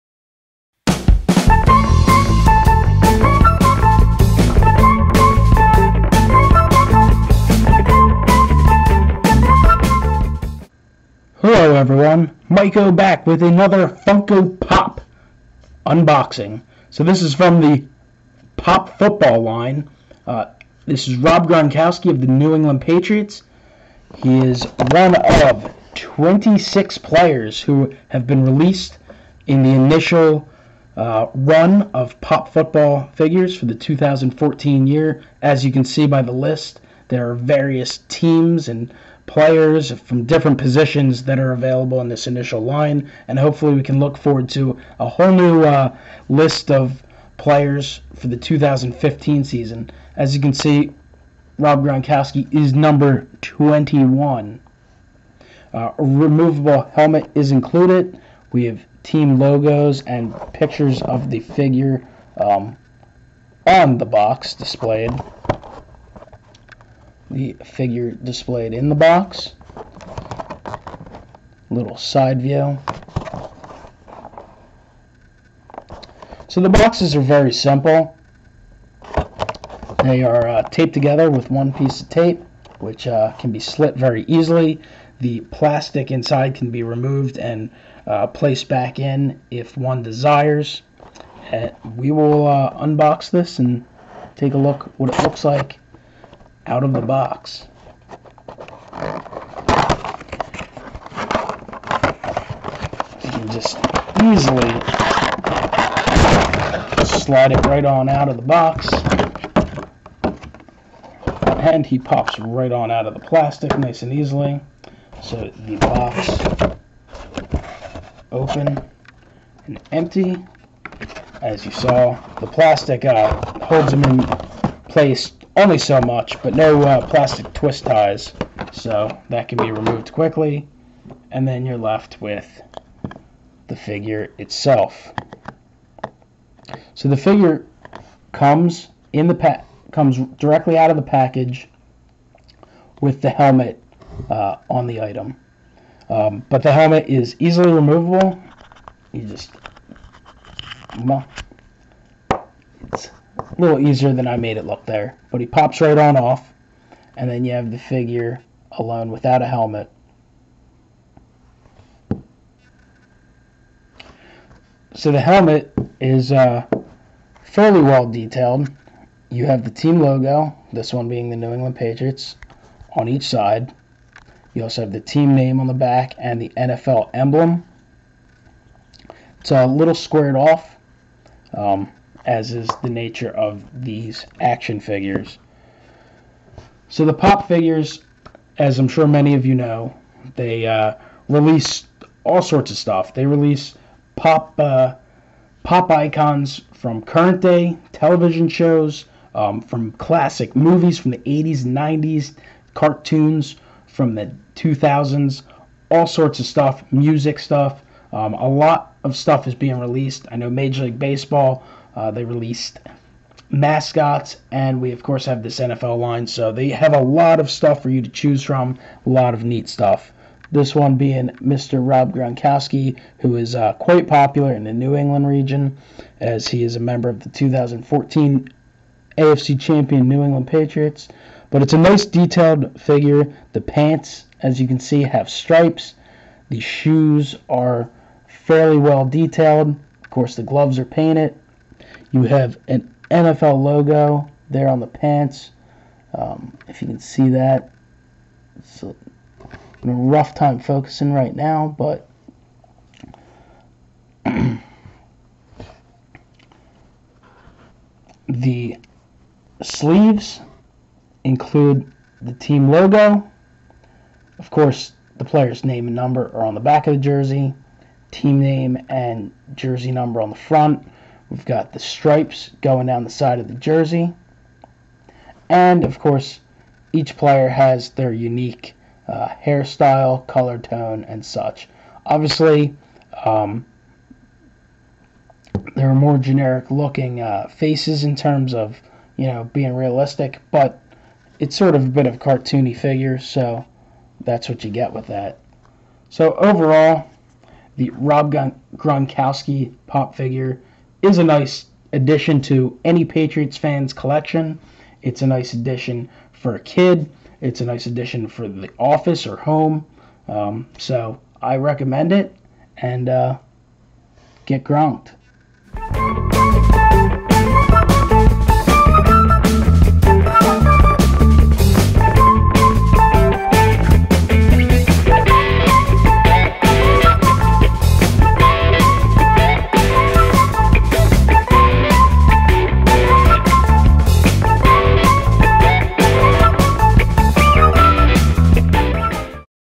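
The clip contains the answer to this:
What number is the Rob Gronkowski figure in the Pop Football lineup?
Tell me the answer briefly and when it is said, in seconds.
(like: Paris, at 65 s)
21, at 53 s.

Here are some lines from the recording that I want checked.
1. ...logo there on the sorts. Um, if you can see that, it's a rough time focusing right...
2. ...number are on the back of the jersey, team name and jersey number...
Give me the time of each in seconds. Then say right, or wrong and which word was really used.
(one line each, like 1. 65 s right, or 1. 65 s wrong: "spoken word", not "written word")
1. 243 s wrong: "pants", not "sorts"
2. 265 s right.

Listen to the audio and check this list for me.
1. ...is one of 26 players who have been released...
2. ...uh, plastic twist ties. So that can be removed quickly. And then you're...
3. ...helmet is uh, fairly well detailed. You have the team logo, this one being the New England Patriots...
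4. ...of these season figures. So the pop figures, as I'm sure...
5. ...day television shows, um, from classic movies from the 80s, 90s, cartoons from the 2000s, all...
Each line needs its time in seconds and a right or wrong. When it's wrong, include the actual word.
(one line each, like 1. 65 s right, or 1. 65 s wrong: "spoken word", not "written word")
1. 24 s right
2. 126 s right
3. 165 s right
4. 183 s wrong: "action", not "season"
5. 197 s right.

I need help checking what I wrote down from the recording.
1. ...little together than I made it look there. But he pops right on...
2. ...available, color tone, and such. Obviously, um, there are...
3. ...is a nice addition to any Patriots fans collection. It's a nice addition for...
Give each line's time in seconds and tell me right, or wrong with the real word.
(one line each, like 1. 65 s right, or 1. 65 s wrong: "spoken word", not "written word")
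1. 153 s wrong: "easier", not "together"
2. 279 s wrong: "hairstyle", not "available"
3. 301 s right.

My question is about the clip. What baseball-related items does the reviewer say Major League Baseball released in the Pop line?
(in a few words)
mascots.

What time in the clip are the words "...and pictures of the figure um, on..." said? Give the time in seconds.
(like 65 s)
60 s.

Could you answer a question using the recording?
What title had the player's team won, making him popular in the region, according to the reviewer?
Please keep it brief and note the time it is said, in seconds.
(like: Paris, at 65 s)
2014 AFC champion, at 227 s.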